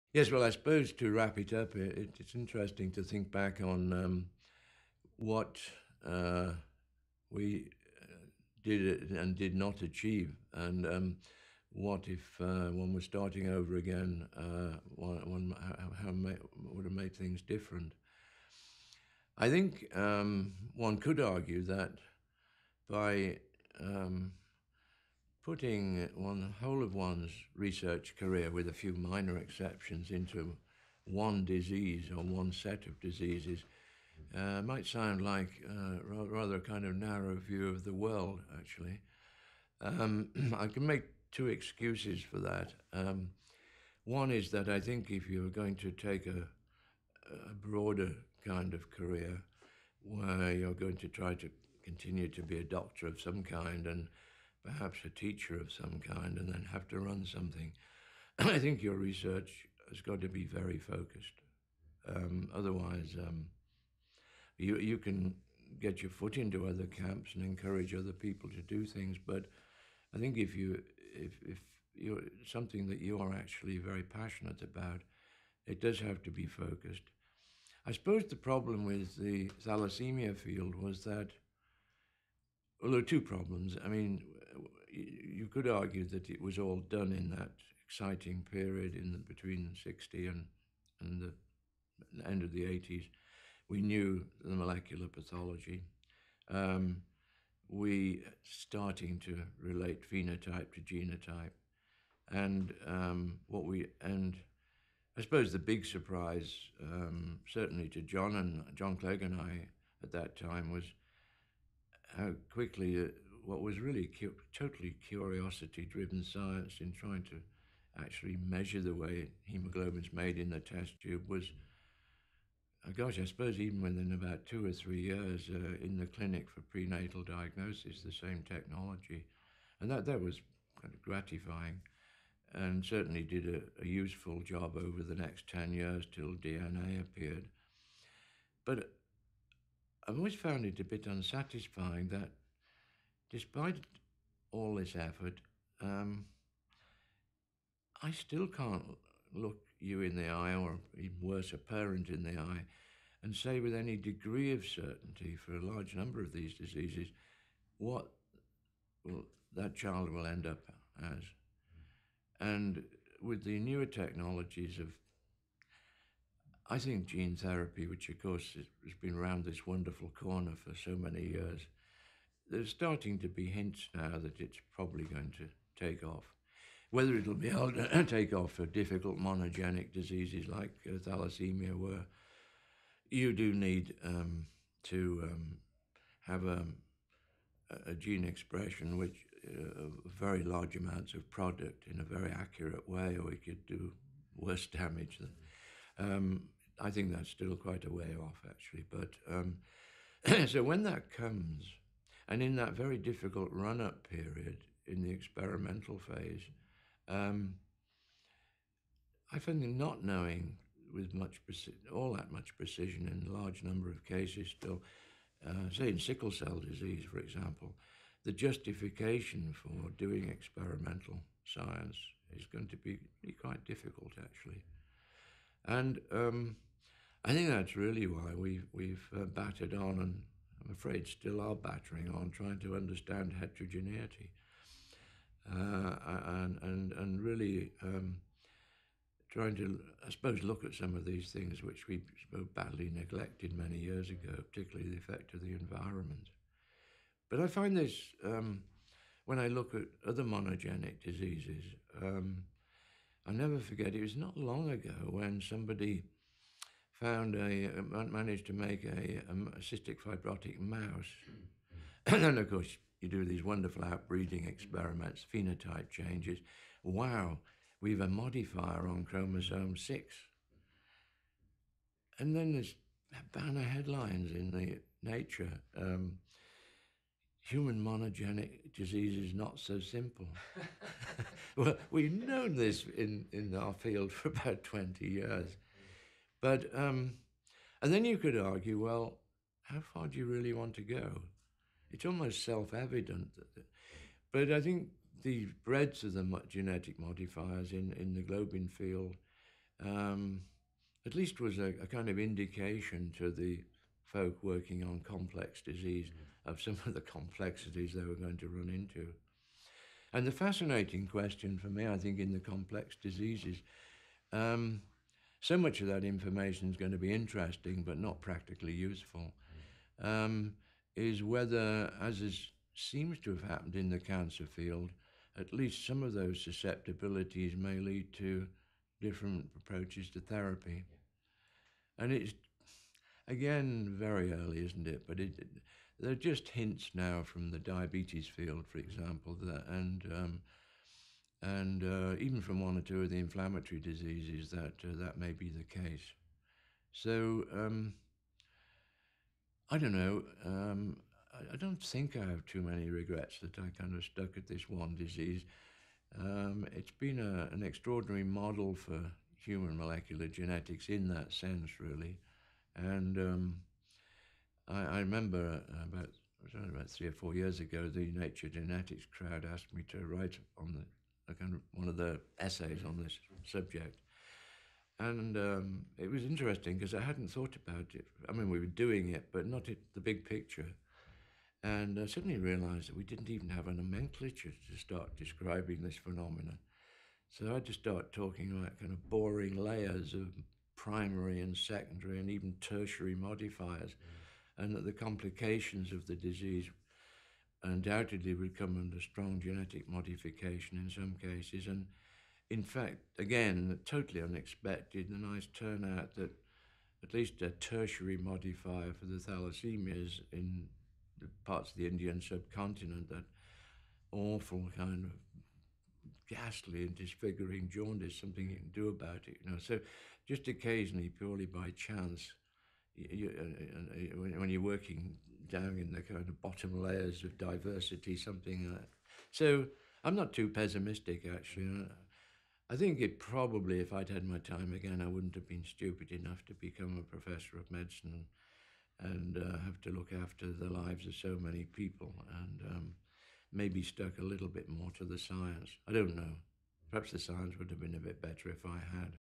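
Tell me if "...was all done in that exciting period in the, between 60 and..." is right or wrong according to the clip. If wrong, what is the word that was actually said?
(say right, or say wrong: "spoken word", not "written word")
right.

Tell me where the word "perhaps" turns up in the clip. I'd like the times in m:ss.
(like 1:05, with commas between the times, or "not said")
0:54, 7:26.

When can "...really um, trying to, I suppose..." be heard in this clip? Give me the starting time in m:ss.
3:57.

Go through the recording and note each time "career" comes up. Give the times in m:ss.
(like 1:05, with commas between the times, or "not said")
0:28, 0:48.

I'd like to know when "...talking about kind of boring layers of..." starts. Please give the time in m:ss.
6:28.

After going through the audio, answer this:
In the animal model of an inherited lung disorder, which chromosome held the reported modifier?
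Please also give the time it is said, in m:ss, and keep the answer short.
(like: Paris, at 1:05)
chromosome 6, at 4:29.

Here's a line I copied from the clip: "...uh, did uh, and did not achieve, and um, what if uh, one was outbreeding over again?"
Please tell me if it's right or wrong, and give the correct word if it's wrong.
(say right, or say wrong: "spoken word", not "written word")
wrong: "starting", not "outbreeding".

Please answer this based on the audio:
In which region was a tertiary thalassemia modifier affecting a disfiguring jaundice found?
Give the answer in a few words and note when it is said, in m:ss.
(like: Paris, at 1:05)
Indian subcontinent, at 6:51.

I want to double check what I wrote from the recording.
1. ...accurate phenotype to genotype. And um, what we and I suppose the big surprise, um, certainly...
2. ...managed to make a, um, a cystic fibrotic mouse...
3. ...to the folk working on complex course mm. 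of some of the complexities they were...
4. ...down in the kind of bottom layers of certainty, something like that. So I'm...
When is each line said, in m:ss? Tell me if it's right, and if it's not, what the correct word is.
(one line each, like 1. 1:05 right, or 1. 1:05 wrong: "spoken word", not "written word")
1. 1:39 wrong: "relate", not "accurate"
2. 4:18 right
3. 5:03 wrong: "disease", not "course"
4. 7:05 wrong: "diversity", not "certainty".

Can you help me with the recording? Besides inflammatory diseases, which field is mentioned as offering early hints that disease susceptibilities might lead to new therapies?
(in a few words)
diabetes.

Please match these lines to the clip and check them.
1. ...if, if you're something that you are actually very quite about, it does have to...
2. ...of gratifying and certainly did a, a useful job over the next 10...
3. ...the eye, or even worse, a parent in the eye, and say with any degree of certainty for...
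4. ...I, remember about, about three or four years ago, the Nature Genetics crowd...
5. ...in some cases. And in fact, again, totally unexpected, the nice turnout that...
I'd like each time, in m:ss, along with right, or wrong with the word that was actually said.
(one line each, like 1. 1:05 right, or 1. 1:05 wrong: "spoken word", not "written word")
1. 1:11 wrong: "passionate", not "quite"
2. 2:10 right
3. 2:30 right
4. 6:04 right
5. 6:40 right.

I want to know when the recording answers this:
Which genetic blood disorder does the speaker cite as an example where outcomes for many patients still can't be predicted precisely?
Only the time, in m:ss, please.
3:35.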